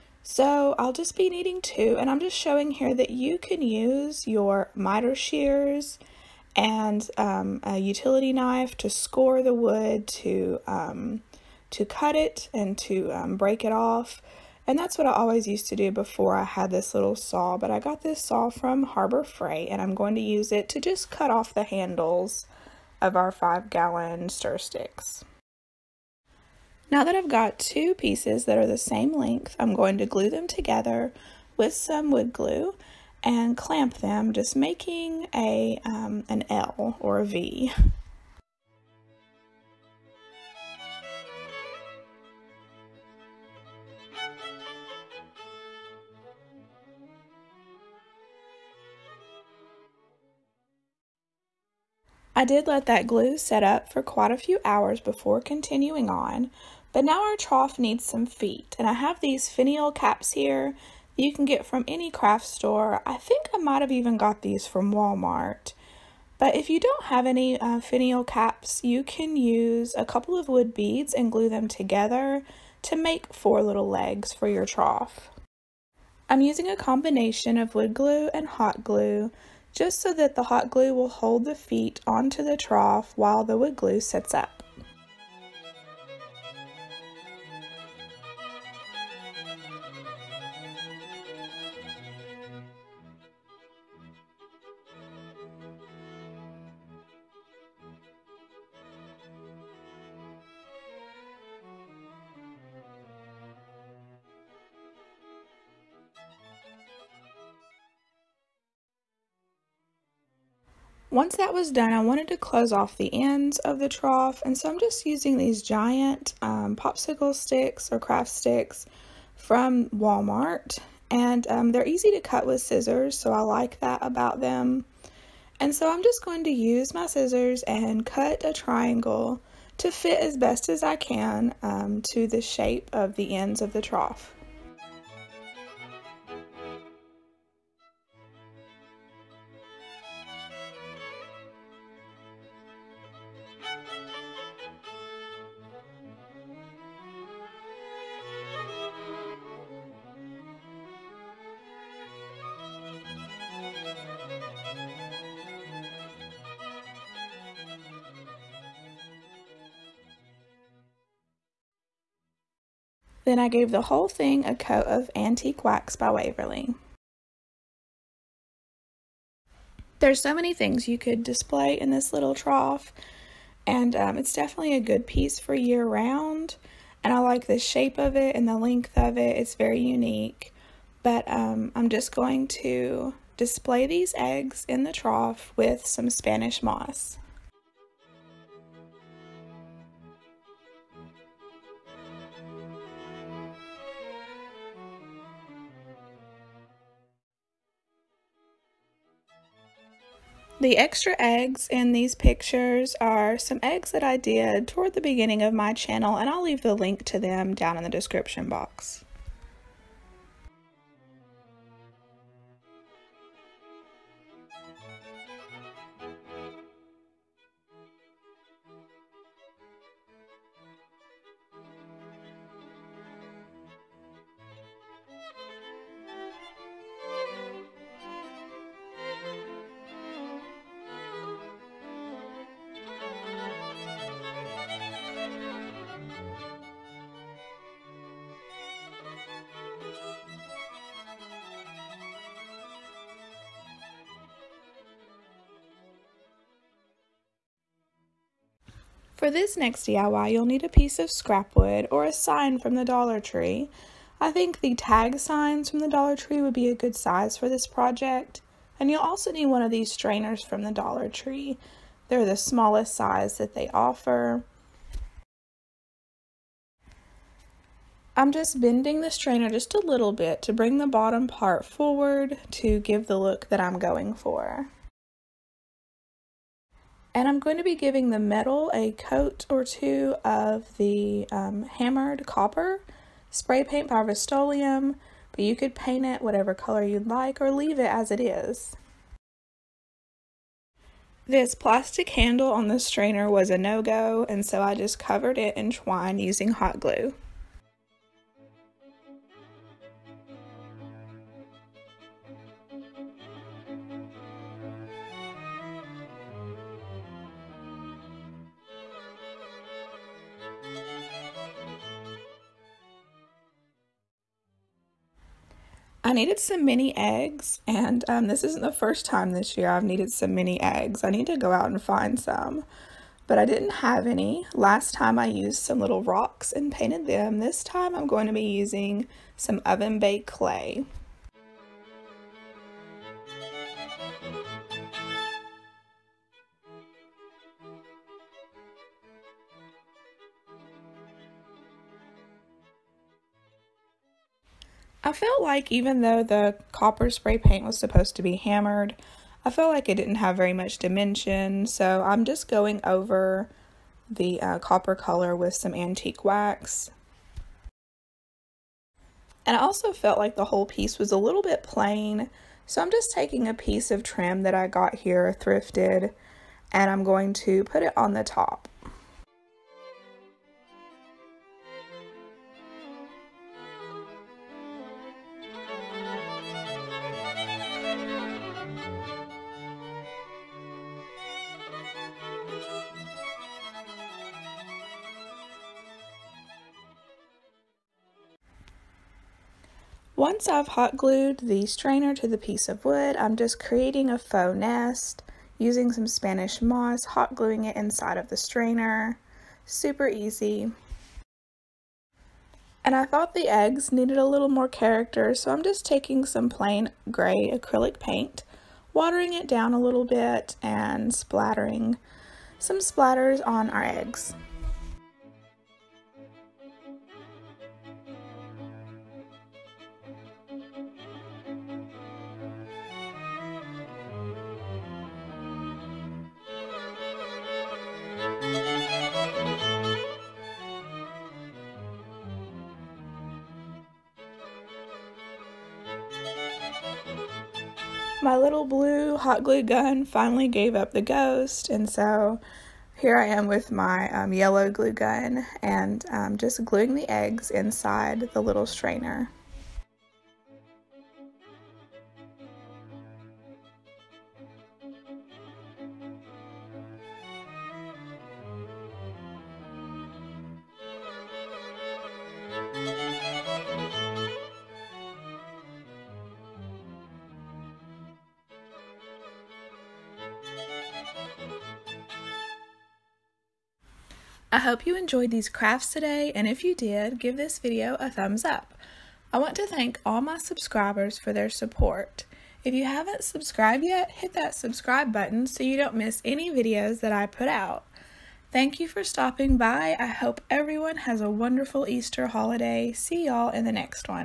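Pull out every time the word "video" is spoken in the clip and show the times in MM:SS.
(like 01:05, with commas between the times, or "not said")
07:57, 08:06.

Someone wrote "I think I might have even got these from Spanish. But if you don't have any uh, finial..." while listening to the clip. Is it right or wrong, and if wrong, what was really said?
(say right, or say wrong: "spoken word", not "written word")
wrong: "Walmart", not "Spanish".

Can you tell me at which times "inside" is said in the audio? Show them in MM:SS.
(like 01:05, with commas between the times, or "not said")
06:37, 07:27.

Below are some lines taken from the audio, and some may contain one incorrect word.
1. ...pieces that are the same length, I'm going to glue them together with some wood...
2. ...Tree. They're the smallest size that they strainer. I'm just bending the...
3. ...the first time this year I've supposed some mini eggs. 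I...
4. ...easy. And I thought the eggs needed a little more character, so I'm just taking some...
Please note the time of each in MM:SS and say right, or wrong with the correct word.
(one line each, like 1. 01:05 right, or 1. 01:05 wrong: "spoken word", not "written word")
1. 00:27 right
2. 04:21 wrong: "offer", not "strainer"
3. 05:18 wrong: "needed", not "supposed"
4. 06:40 right.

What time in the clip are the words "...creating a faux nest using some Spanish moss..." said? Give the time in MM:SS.
06:33.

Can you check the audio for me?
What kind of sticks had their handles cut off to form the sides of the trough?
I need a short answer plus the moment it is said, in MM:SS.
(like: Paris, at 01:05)
five gallon stir sticks, at 00:23.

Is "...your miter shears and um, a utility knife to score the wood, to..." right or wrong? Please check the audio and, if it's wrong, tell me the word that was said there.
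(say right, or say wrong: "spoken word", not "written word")
right.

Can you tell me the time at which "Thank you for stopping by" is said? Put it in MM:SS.
08:08.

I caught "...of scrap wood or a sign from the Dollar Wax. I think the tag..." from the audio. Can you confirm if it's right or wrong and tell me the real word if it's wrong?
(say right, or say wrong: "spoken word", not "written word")
wrong: "Tree", not "Wax".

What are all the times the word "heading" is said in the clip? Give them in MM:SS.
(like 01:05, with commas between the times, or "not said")
not said.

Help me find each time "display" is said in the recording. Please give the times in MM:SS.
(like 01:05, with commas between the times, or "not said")
02:51, 03:03.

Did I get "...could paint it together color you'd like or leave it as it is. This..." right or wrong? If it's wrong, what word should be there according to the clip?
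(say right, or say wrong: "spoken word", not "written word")
wrong: "whatever", not "together".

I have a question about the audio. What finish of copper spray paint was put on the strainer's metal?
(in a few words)
hammered copper.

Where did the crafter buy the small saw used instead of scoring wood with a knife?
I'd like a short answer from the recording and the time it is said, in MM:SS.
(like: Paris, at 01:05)
Harbor Freight, at 00:18.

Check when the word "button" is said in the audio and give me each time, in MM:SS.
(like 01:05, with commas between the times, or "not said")
08:05.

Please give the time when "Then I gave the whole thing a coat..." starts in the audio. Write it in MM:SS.
02:43.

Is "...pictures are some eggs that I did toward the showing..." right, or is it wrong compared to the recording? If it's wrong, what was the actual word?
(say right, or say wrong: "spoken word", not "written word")
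wrong: "beginning", not "showing".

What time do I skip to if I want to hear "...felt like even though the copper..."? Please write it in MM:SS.
05:45.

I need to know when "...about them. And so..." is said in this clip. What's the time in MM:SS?
02:04.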